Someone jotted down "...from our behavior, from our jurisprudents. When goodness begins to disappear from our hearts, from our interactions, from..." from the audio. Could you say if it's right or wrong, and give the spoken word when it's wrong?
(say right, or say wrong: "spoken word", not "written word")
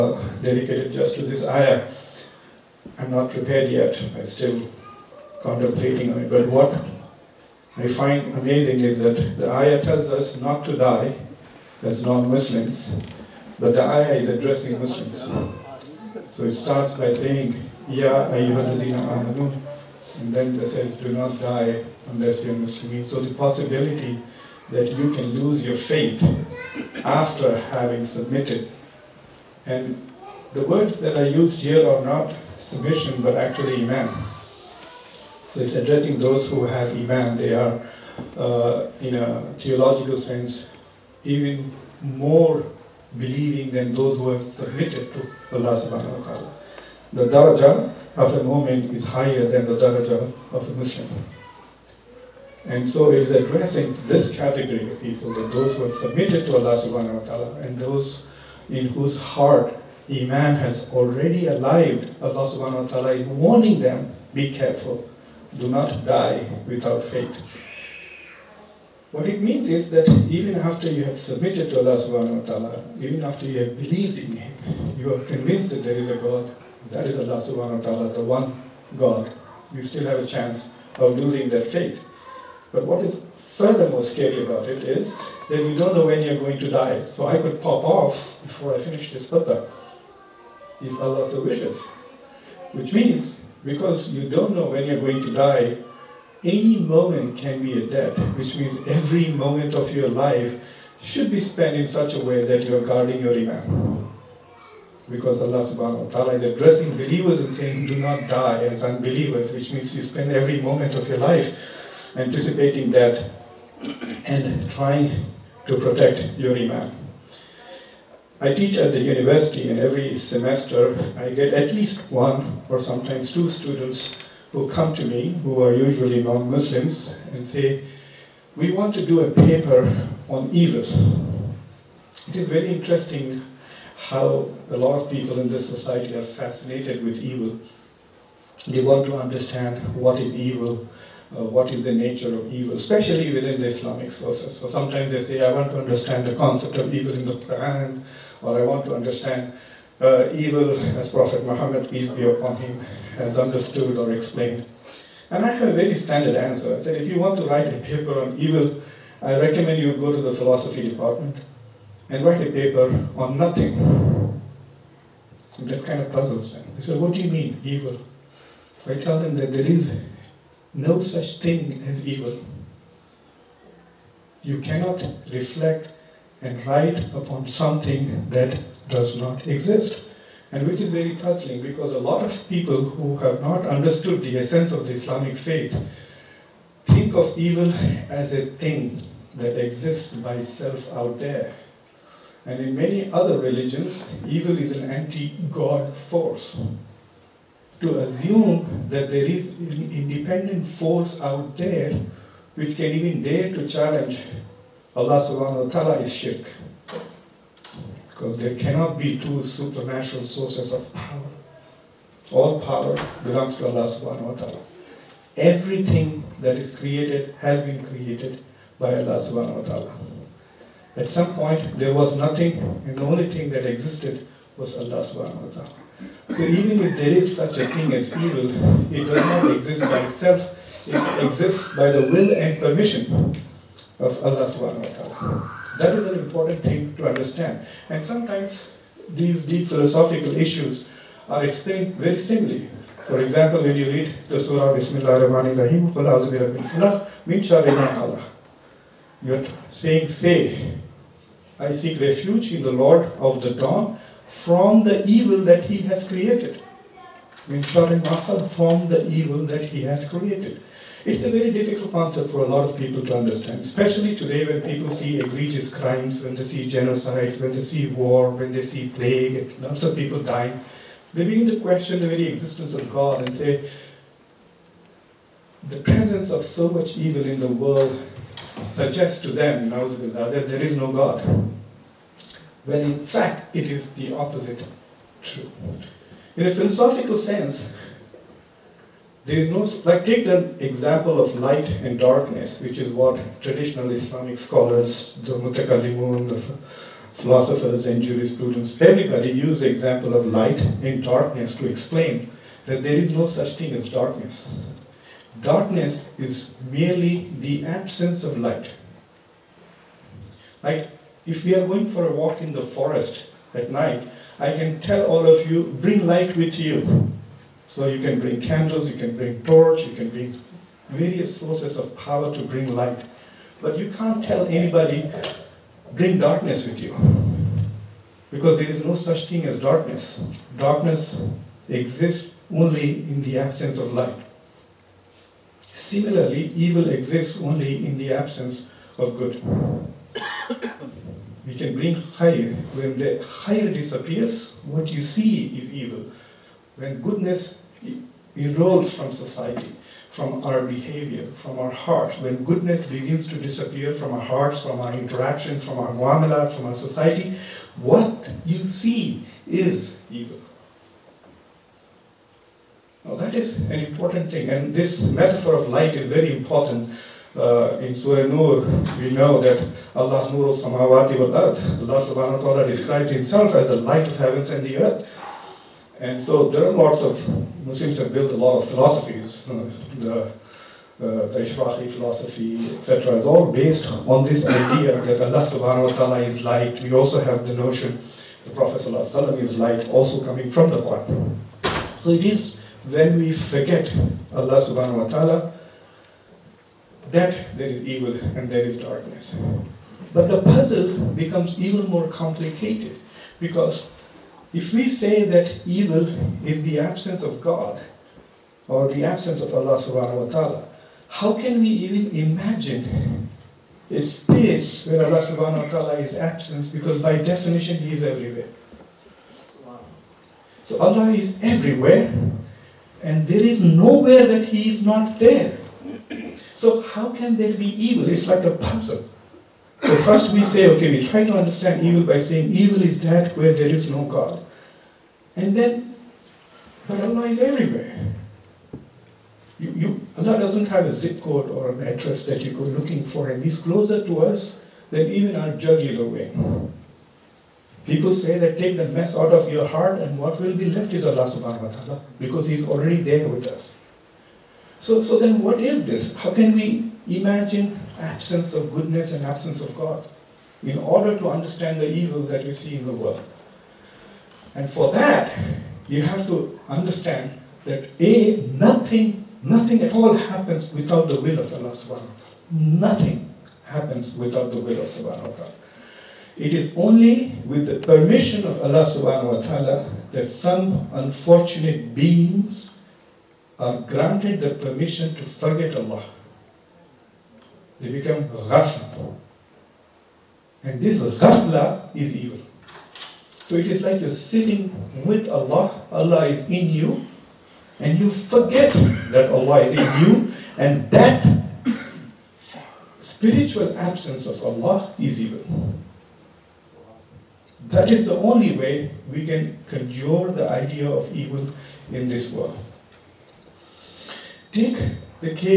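wrong: "hearts", not "jurisprudents".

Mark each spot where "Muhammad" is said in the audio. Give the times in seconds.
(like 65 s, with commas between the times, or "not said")
151 s.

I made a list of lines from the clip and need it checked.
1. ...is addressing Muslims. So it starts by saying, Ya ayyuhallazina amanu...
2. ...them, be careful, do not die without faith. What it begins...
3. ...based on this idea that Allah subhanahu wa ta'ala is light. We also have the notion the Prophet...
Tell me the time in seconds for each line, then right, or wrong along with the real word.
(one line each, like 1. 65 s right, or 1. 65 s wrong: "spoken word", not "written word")
1. 14 s right
2. 63 s wrong: "means", not "begins"
3. 383 s right.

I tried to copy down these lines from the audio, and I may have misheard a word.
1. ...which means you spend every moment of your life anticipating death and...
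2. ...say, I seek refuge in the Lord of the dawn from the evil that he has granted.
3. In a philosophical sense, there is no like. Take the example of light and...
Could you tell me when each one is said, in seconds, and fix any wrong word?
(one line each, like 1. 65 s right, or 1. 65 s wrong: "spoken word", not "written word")
1. 109 s right
2. 250 s wrong: "created", not "granted"
3. 286 s right.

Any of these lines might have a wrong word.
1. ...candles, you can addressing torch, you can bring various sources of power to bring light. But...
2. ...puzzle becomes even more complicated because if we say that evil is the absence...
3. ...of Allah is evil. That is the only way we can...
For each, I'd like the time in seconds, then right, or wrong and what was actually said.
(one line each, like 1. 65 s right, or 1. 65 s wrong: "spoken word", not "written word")
1. 318 s wrong: "bring", not "addressing"
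2. 400 s right
3. 504 s right.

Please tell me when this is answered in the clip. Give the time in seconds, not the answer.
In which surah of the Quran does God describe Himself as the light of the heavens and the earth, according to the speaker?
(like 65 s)
367 s.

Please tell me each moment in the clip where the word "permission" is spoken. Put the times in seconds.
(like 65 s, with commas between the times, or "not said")
232 s, 477 s, 484 s.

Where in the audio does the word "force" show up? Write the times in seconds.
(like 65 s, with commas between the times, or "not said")
196 s, 200 s.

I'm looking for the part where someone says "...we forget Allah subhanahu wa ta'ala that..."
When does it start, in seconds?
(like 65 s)
393 s.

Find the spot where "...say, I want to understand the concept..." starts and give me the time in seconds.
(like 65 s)
145 s.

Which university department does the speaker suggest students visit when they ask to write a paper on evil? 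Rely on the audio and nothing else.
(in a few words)
philosophy department.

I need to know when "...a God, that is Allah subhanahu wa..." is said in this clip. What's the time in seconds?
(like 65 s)
76 s.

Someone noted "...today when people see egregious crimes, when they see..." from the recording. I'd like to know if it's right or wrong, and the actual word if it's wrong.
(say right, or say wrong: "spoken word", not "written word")
right.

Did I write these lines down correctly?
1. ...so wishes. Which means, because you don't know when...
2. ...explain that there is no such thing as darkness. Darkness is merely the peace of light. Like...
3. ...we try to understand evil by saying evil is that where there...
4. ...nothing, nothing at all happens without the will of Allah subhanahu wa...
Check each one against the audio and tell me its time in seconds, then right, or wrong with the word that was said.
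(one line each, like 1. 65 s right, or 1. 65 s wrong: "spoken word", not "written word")
1. 91 s right
2. 301 s wrong: "absence", not "peace"
3. 430 s right
4. 468 s right.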